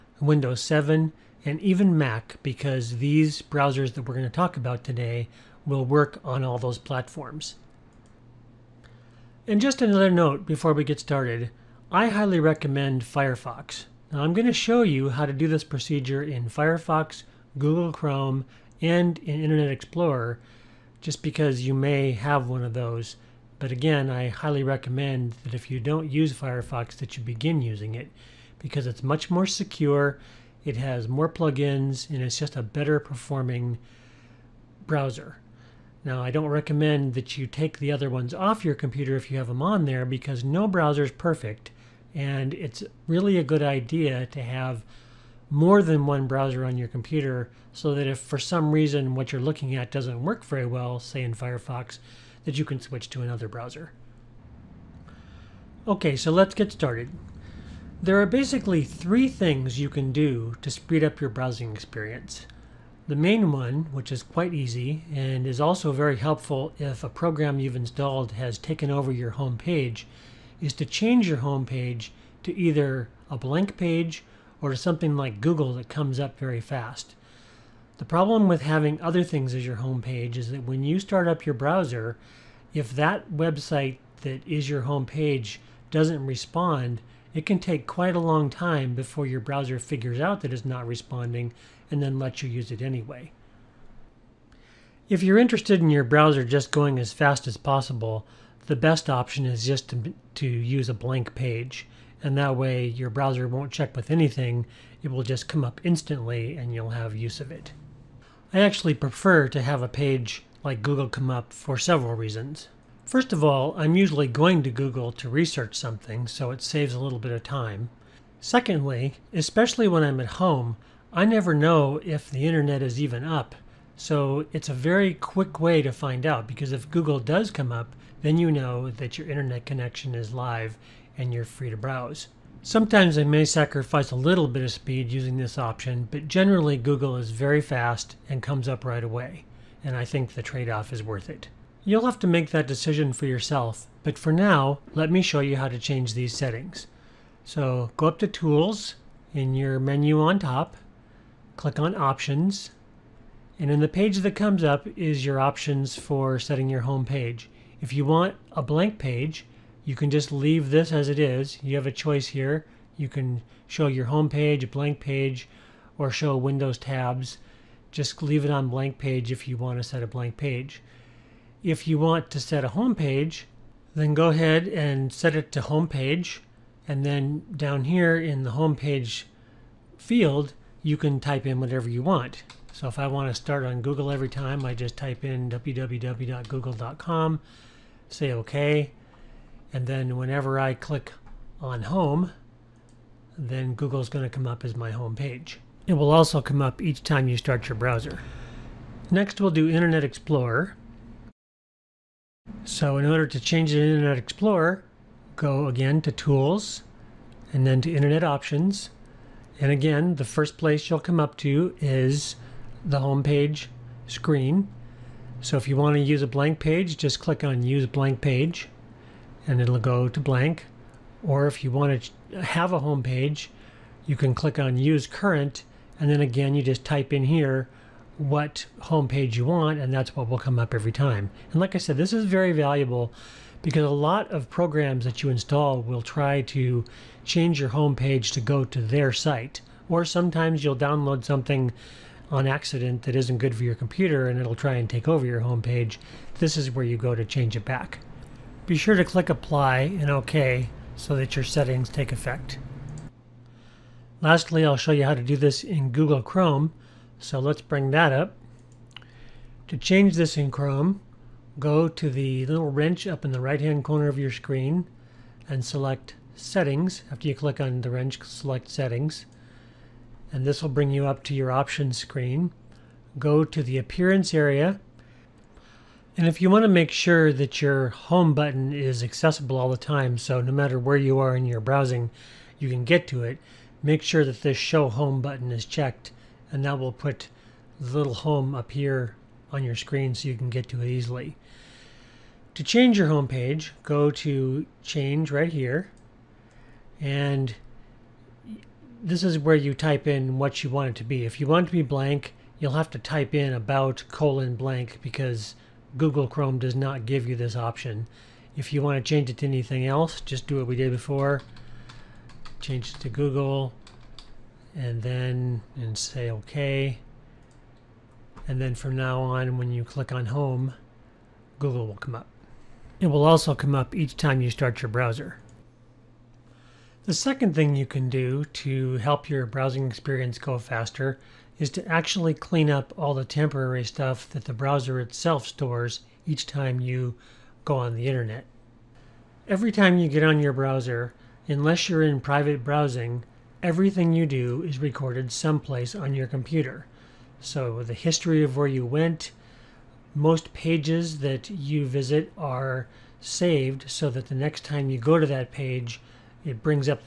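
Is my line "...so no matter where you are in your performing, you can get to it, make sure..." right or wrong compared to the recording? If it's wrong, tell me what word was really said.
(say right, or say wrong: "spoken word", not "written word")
wrong: "browsing", not "performing".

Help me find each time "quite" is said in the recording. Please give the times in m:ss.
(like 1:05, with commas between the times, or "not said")
1:04, 1:27.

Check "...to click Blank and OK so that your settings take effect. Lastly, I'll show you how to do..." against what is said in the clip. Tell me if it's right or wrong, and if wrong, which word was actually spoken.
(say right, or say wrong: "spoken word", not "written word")
wrong: "Apply", not "Blank".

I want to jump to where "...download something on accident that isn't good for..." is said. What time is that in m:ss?
4:00.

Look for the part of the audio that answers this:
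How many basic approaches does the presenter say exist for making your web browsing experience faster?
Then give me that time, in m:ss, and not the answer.
0:58.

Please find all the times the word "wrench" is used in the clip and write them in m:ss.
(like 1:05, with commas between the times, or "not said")
4:22, 4:27.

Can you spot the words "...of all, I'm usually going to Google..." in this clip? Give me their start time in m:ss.
1:53.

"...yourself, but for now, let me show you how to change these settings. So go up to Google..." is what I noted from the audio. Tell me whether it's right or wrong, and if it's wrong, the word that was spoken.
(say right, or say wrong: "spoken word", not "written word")
wrong: "Tools", not "Google".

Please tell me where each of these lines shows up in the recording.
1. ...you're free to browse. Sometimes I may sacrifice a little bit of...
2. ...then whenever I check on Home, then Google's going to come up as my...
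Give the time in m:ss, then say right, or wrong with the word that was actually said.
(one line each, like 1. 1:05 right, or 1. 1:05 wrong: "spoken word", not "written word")
1. 2:11 right
2. 3:09 wrong: "click", not "check".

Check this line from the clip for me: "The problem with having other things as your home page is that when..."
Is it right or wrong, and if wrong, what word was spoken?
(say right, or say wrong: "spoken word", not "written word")
right.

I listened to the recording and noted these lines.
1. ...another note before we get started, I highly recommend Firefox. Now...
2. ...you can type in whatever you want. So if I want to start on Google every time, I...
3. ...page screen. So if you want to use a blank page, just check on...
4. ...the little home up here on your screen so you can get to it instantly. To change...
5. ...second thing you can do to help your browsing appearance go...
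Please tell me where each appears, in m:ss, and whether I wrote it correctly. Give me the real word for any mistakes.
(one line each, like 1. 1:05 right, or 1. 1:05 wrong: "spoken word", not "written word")
1. 0:09 right
2. 3:00 right
3. 3:33 wrong: "click", not "check"
4. 4:47 wrong: "easily", not "instantly"
5. 5:27 wrong: "experience", not "appearance".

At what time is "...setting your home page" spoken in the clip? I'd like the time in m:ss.
2:36.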